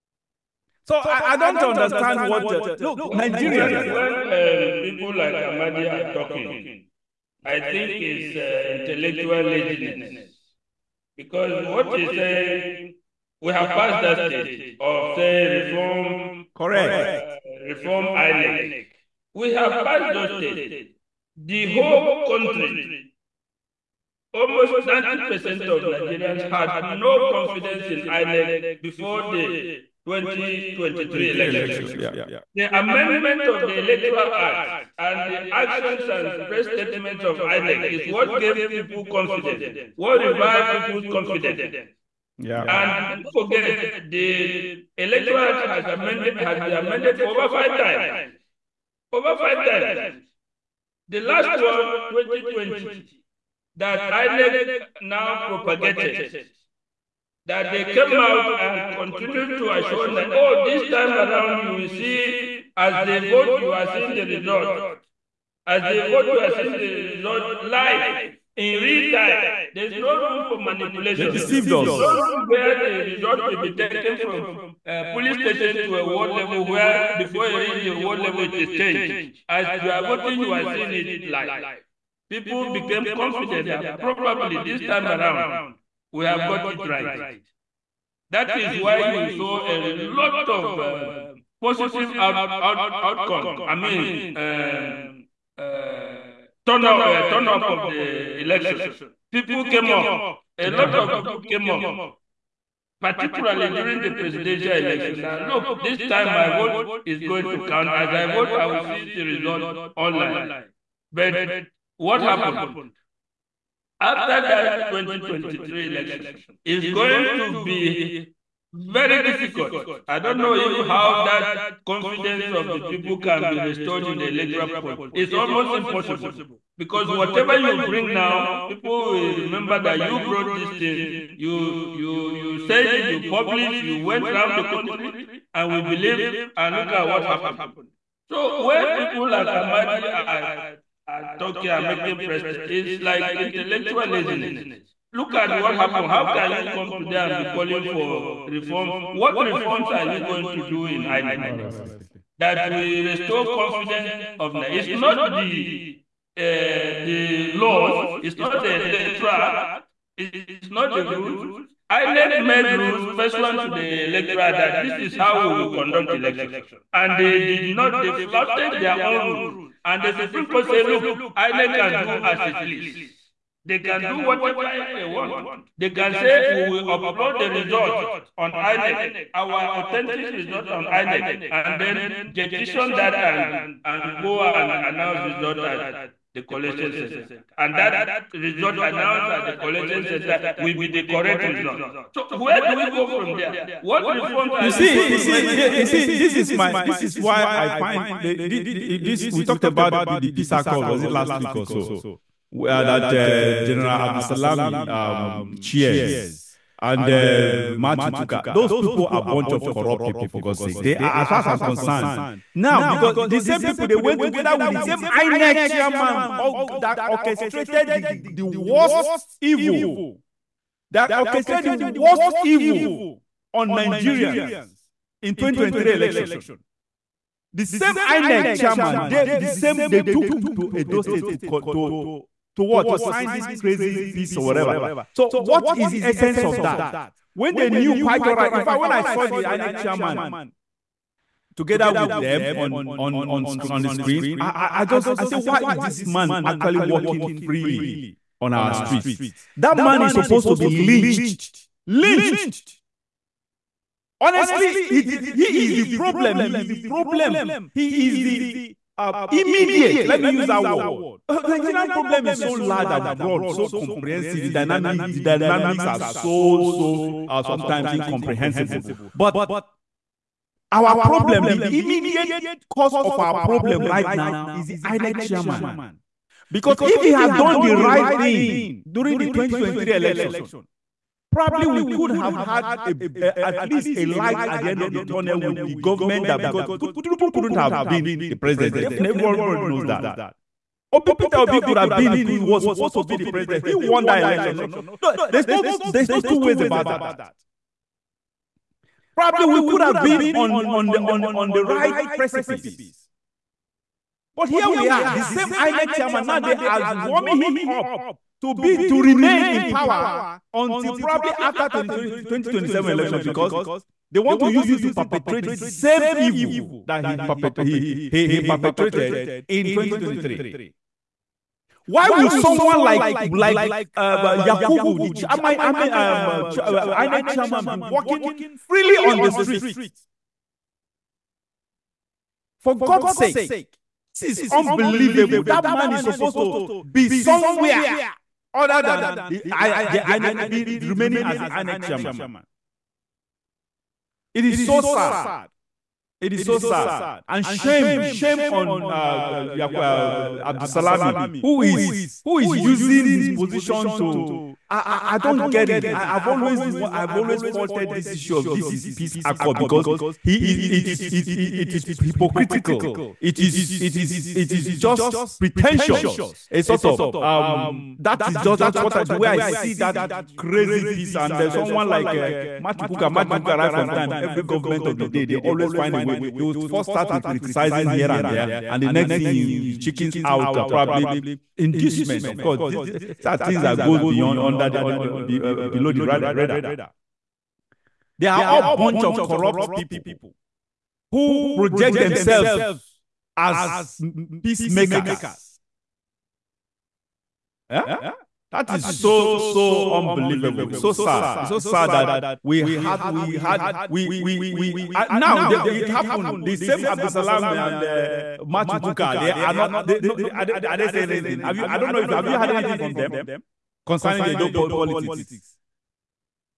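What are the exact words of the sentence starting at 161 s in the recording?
INEC made rules pursuant to the electoral that this is how we will conduct election.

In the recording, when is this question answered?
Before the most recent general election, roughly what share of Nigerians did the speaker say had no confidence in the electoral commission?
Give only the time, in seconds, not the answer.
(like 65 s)
24 s.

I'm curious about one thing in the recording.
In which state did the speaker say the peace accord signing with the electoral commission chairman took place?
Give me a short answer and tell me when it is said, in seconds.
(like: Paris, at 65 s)
Edo State, at 230 s.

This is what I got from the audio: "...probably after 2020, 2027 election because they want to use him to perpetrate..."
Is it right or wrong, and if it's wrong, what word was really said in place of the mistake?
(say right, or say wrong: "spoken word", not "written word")
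right.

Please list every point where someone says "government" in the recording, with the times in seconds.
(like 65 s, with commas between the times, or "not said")
285 s, 374 s.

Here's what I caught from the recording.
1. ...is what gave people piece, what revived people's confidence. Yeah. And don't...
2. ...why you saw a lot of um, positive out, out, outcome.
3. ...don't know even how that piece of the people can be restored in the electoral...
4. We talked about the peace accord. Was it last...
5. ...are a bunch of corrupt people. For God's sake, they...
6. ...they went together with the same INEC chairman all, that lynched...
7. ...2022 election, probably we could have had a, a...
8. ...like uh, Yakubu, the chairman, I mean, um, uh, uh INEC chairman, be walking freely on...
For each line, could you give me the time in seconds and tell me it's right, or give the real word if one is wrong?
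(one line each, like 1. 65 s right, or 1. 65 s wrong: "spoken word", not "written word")
1. 37 s wrong: "confidence", not "piece"
2. 88 s right
3. 120 s wrong: "confidence", not "piece"
4. 199 s right
5. 209 s right
6. 213 s wrong: "orchestrated", not "lynched"
7. 279 s wrong: "2023", not "2022"
8. 323 s right.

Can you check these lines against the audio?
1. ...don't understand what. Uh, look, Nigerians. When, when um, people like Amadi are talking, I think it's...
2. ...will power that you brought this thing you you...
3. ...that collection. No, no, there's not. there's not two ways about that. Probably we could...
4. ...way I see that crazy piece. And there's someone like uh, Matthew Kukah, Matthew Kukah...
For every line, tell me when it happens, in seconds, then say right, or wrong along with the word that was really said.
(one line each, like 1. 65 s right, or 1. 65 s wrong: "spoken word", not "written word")
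1. 1 s right
2. 129 s wrong: "remember", not "power"
3. 294 s wrong: "election", not "collection"
4. 369 s right.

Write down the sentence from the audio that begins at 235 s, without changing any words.
So, what is the essence of that?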